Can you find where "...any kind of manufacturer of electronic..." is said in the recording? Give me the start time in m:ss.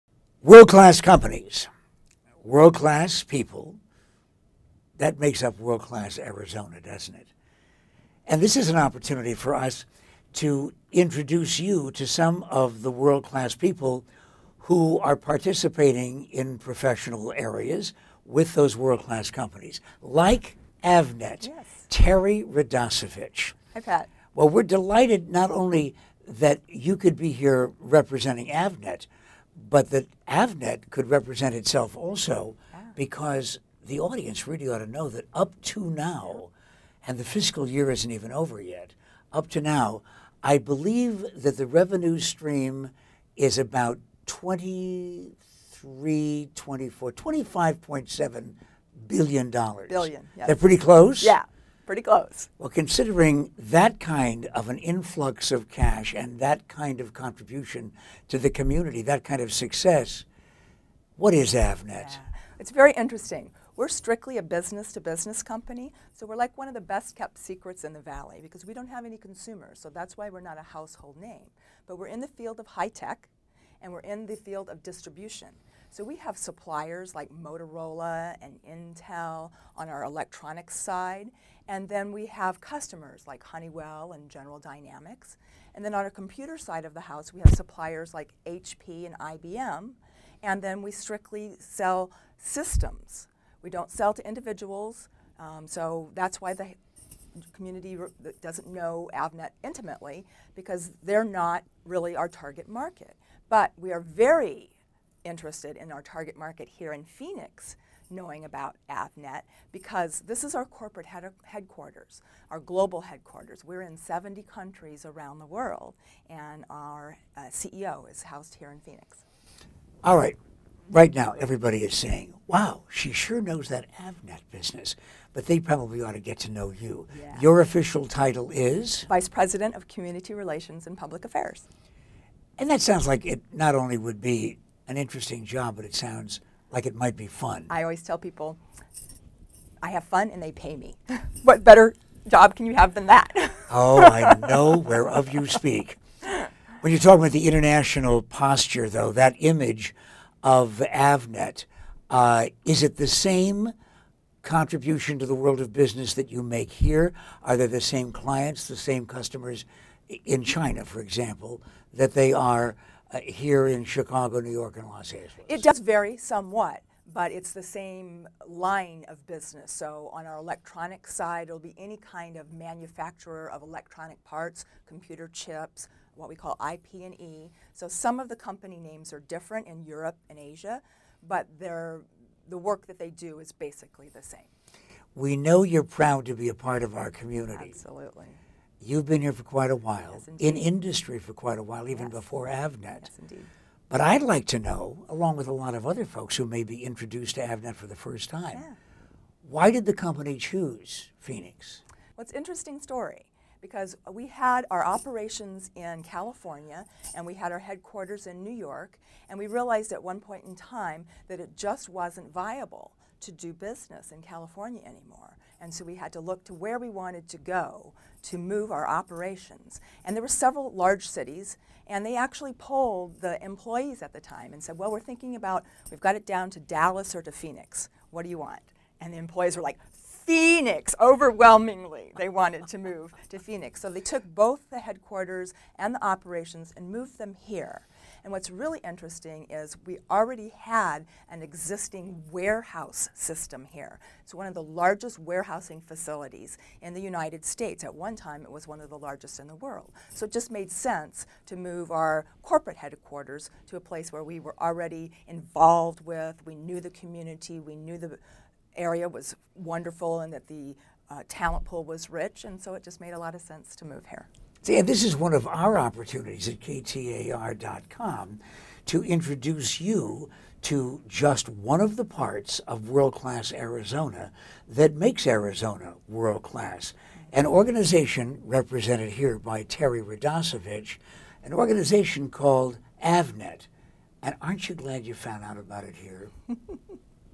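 2:51.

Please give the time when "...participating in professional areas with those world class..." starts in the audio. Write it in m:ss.
0:15.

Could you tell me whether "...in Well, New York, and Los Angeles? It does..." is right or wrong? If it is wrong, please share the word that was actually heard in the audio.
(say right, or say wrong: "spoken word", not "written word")
wrong: "Chicago", not "Well".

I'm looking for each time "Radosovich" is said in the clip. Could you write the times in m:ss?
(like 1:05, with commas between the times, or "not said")
0:22, 4:40.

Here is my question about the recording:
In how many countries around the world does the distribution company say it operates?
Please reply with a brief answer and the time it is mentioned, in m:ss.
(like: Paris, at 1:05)
70, at 1:53.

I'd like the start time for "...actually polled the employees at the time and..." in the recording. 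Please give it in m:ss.
3:42.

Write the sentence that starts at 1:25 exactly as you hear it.
And then on our computer side of the house, we have suppliers like HP and IBM, and then we strictly sell systems.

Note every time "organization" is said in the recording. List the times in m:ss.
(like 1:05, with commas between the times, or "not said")
4:37, 4:41.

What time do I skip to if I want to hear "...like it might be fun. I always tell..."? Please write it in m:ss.
2:16.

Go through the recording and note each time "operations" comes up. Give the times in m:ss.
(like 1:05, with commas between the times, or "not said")
3:24, 3:38, 3:56.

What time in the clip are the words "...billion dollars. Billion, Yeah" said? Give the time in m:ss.
0:49.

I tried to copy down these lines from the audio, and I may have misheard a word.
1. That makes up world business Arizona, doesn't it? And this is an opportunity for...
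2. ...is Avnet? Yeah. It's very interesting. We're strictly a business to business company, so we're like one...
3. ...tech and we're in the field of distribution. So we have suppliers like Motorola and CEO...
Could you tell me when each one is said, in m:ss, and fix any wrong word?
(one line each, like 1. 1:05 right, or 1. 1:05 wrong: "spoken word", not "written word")
1. 0:04 wrong: "class", not "business"
2. 1:01 right
3. 1:12 wrong: "Intel", not "CEO".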